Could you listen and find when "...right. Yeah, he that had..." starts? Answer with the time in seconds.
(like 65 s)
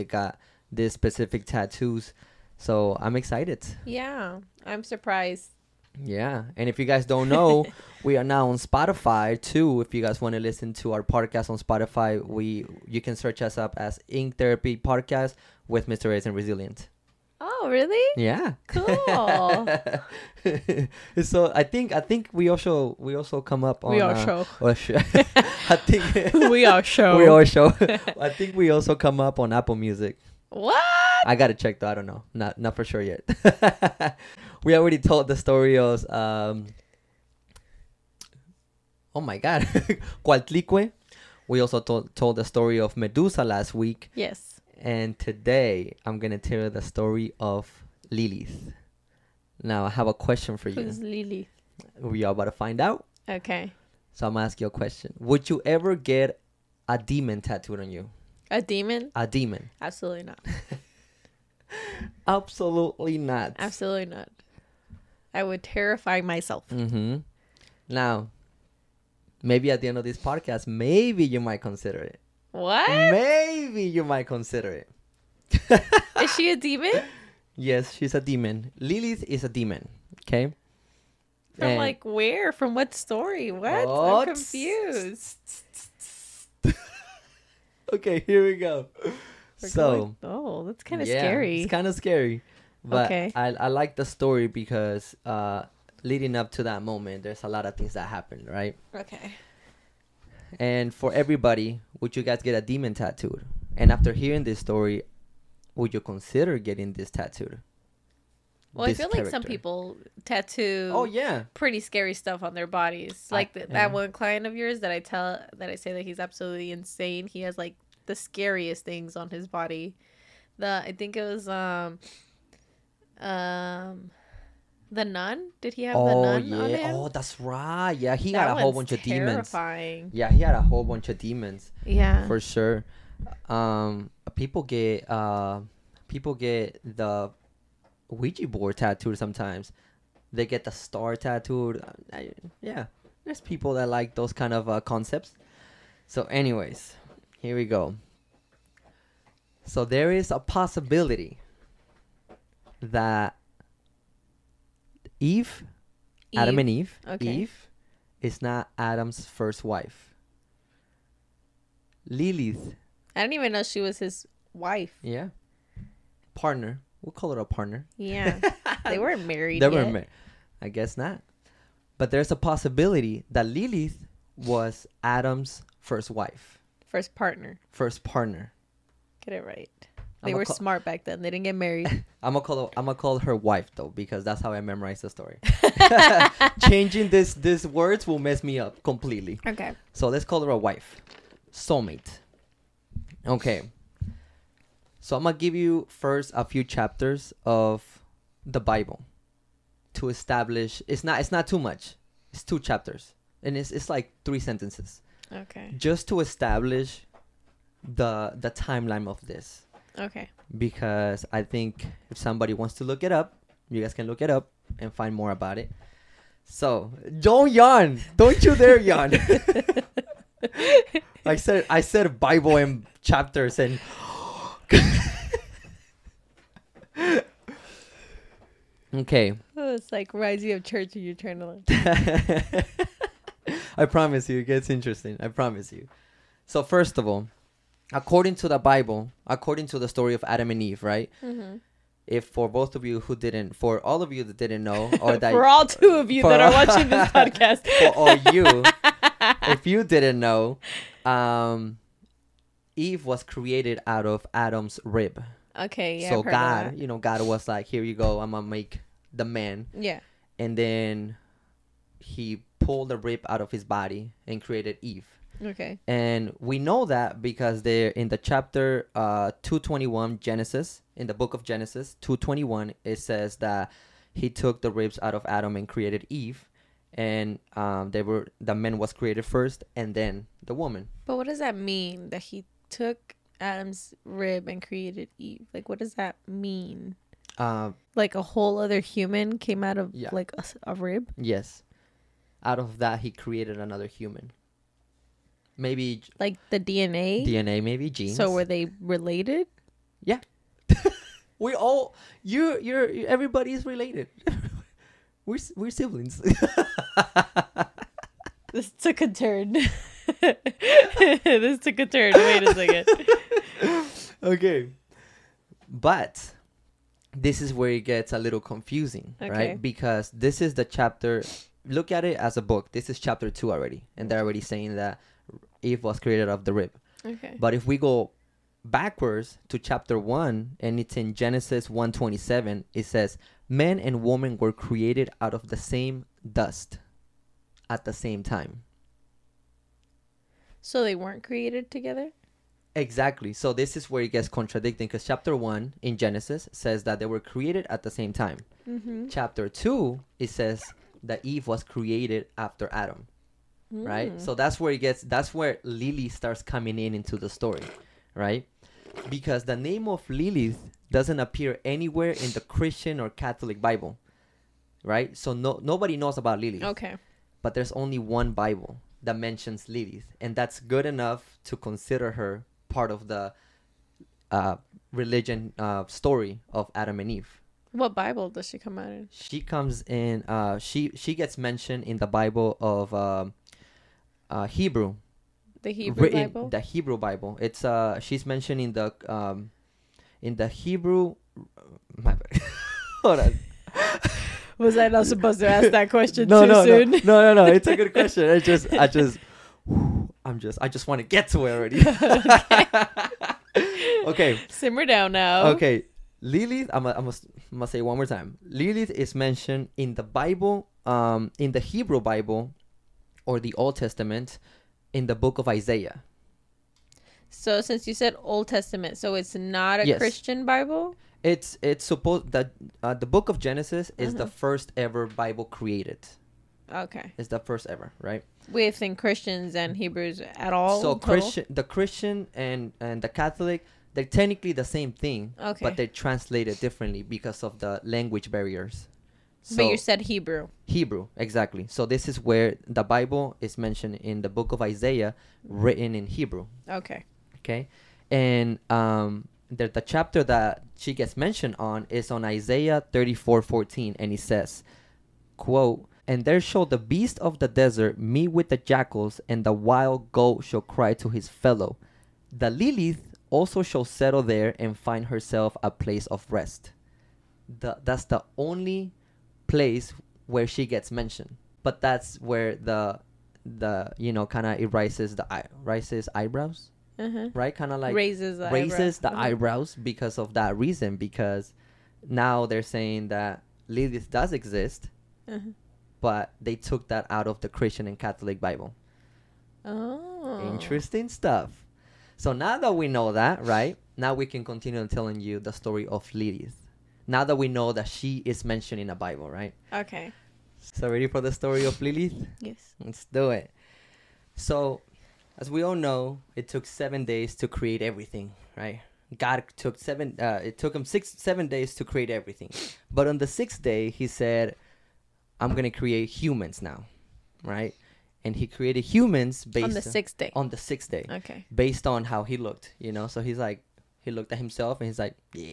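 127 s.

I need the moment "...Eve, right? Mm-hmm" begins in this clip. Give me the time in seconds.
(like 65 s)
240 s.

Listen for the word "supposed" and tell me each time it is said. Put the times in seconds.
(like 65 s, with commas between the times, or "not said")
395 s, 421 s.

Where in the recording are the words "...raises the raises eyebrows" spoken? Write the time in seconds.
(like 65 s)
477 s.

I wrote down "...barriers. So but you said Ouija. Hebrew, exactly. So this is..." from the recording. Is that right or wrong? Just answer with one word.
wrong.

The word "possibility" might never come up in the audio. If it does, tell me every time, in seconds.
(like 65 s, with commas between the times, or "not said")
150 s, 172 s.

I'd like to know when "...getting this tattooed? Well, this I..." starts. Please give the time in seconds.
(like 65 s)
106 s.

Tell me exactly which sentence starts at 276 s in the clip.
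And um, they were the man was created first, and then the woman.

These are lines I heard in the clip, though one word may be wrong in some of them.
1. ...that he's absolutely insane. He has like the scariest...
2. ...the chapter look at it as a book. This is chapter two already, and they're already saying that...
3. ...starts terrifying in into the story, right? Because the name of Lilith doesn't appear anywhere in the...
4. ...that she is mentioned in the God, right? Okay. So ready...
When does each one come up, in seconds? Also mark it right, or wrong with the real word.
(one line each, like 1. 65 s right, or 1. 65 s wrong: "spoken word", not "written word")
1. 115 s right
2. 320 s right
3. 356 s wrong: "coming", not "terrifying"
4. 497 s wrong: "Bible", not "God".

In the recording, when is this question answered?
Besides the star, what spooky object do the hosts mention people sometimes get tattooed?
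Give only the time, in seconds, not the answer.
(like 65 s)
138 s.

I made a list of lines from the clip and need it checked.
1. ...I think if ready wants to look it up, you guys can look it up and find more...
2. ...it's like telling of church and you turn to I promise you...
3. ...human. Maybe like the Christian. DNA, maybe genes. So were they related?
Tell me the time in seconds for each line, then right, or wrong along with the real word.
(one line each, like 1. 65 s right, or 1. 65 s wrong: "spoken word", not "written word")
1. 211 s wrong: "somebody", not "ready"
2. 229 s wrong: "rising", not "telling"
3. 293 s wrong: "DNA", not "Christian".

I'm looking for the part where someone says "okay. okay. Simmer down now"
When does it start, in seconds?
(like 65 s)
401 s.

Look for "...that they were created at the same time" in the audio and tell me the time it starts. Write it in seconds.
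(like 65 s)
346 s.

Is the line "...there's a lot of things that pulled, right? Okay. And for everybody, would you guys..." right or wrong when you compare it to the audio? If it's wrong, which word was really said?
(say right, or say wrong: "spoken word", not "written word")
wrong: "happened", not "pulled".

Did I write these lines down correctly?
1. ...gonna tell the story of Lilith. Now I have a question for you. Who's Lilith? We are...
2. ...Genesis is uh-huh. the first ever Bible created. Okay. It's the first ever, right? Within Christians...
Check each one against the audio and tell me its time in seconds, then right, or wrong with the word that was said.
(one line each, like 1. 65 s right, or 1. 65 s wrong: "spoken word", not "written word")
1. 46 s right
2. 423 s right.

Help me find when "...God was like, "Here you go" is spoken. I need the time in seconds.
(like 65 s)
256 s.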